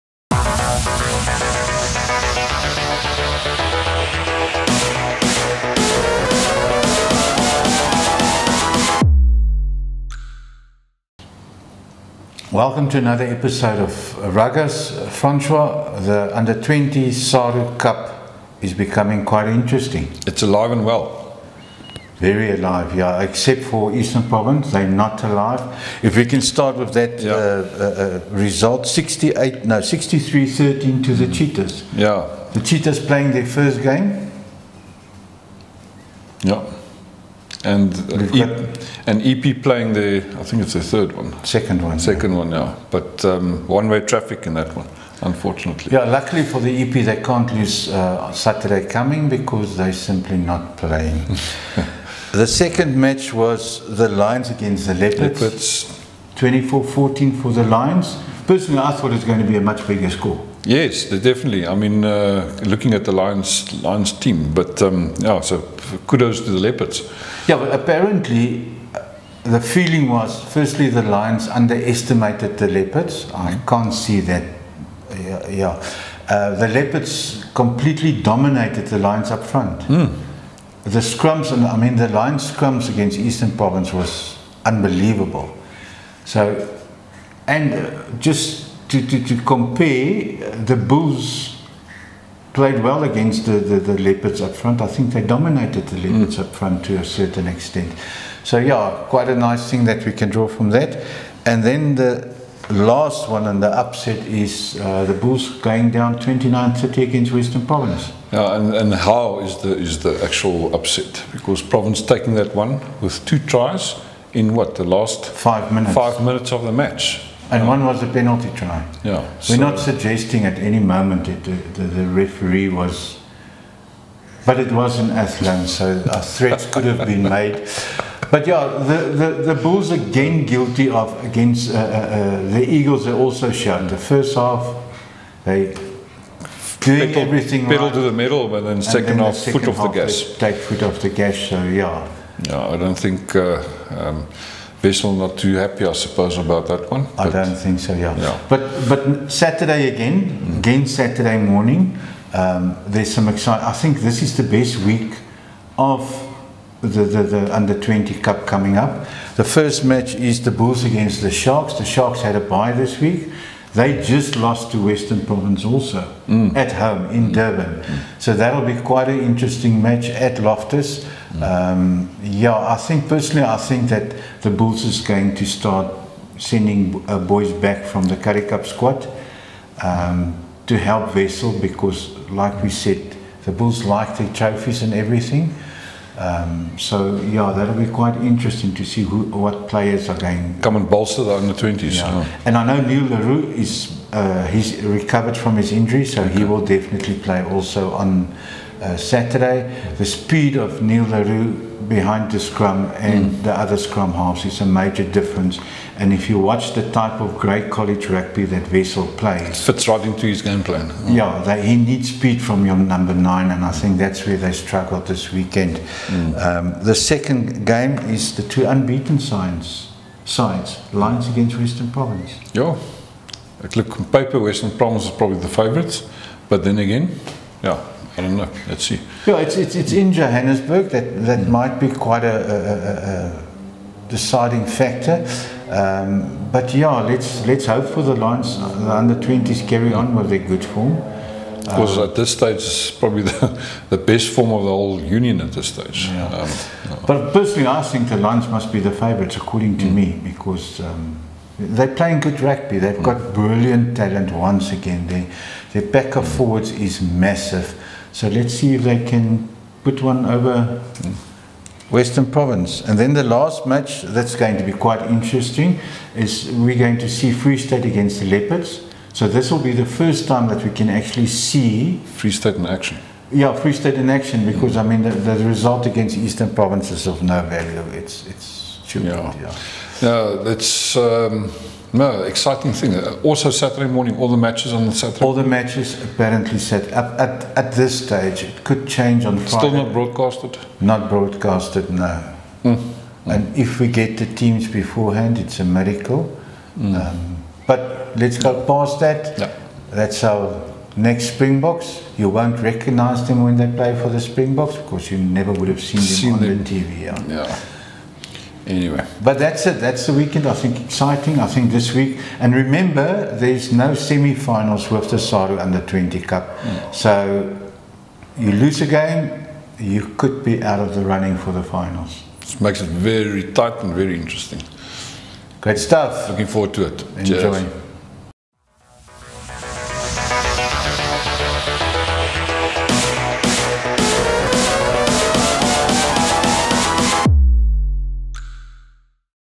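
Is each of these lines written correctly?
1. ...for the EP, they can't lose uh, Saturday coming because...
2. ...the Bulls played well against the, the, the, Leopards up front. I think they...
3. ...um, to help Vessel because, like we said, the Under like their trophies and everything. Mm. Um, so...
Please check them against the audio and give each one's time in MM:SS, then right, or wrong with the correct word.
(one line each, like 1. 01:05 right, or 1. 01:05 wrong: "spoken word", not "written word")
1. 00:46 right
2. 01:30 right
3. 02:59 wrong: "Bulls", not "Under".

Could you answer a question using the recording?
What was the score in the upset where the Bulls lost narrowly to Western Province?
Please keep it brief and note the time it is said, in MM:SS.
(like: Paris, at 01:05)
29-30, at 01:46.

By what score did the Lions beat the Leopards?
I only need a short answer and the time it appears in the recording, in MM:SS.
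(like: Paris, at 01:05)
24-14, at 00:56.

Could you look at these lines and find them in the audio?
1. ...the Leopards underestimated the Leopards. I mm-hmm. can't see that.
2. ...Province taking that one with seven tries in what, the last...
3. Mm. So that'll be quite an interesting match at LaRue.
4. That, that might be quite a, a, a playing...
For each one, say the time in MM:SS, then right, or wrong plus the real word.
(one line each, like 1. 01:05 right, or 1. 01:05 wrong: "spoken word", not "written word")
1. 01:10 wrong: "Lions", not "Leopards"
2. 01:51 wrong: "two", not "seven"
3. 02:47 wrong: "Loftus", not "LaRue"
4. 03:50 wrong: "deciding", not "playing".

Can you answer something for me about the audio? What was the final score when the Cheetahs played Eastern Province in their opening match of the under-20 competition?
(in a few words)
63-13.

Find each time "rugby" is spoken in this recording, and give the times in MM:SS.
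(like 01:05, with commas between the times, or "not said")
03:28, 04:12.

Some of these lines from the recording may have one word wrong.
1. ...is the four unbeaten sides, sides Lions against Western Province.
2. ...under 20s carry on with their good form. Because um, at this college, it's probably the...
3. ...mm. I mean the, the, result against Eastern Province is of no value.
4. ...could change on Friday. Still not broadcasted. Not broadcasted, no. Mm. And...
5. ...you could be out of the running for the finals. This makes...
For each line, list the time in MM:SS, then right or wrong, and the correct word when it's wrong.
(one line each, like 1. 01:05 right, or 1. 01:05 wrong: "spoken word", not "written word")
1. 03:38 wrong: "two", not "four"
2. 03:58 wrong: "stage", not "college"
3. 04:34 right
4. 04:48 right
5. 05:19 right.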